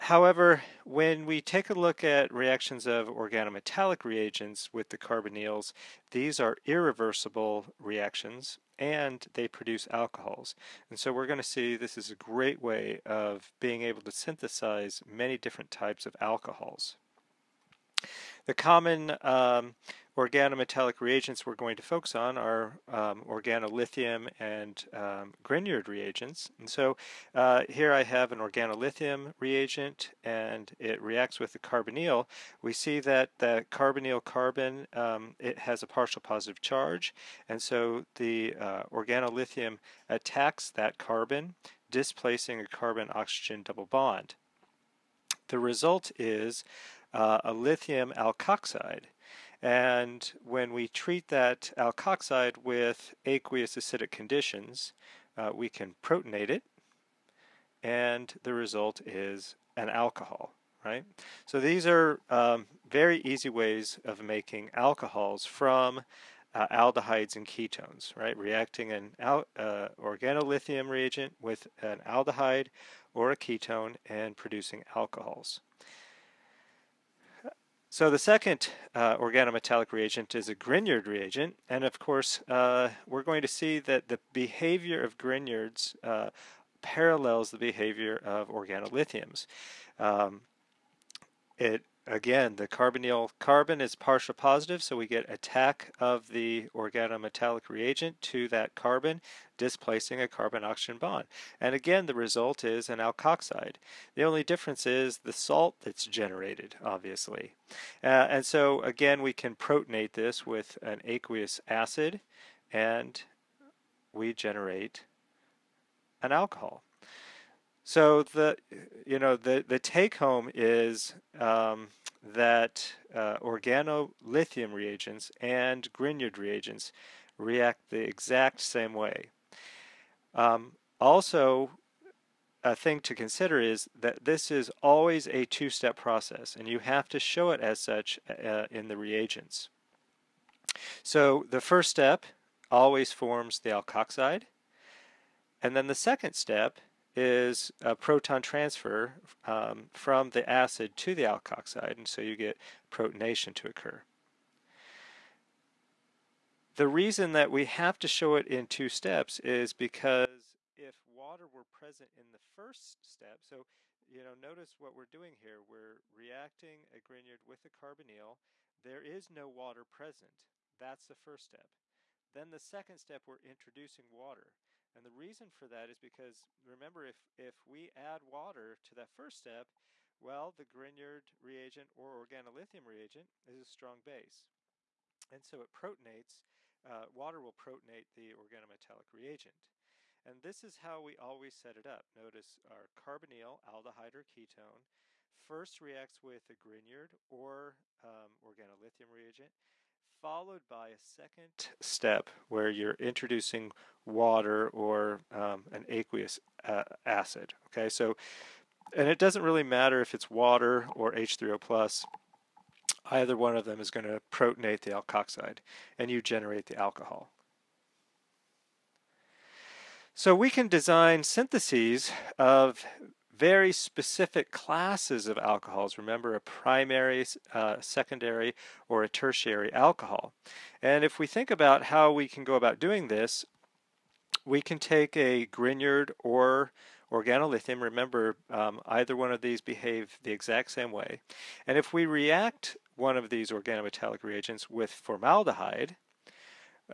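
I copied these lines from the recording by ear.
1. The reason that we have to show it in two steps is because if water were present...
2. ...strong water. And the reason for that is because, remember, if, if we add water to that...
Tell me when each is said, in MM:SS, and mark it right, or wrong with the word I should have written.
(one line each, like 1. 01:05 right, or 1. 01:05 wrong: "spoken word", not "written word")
1. 02:36 right
2. 02:53 wrong: "introducing", not "strong".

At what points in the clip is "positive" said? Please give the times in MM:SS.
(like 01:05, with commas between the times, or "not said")
00:36, 01:34.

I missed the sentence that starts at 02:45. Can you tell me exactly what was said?
We're reacting a Grignard with a carbonyl.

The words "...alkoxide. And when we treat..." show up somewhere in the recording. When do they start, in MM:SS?
00:48.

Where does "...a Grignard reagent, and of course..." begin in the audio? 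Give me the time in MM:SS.
01:20.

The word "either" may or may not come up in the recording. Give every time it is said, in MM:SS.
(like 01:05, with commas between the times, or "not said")
03:33, 03:58.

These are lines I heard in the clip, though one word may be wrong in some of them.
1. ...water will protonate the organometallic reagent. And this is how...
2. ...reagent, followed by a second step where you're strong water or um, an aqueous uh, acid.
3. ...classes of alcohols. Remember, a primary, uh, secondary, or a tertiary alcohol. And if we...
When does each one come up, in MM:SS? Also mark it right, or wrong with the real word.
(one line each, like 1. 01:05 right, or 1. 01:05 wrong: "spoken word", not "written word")
1. 03:07 right
2. 03:19 wrong: "introducing", not "strong"
3. 03:44 right.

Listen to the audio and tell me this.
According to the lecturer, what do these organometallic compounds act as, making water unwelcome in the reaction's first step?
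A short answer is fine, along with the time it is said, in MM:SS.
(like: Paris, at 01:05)
a strong base, at 03:03.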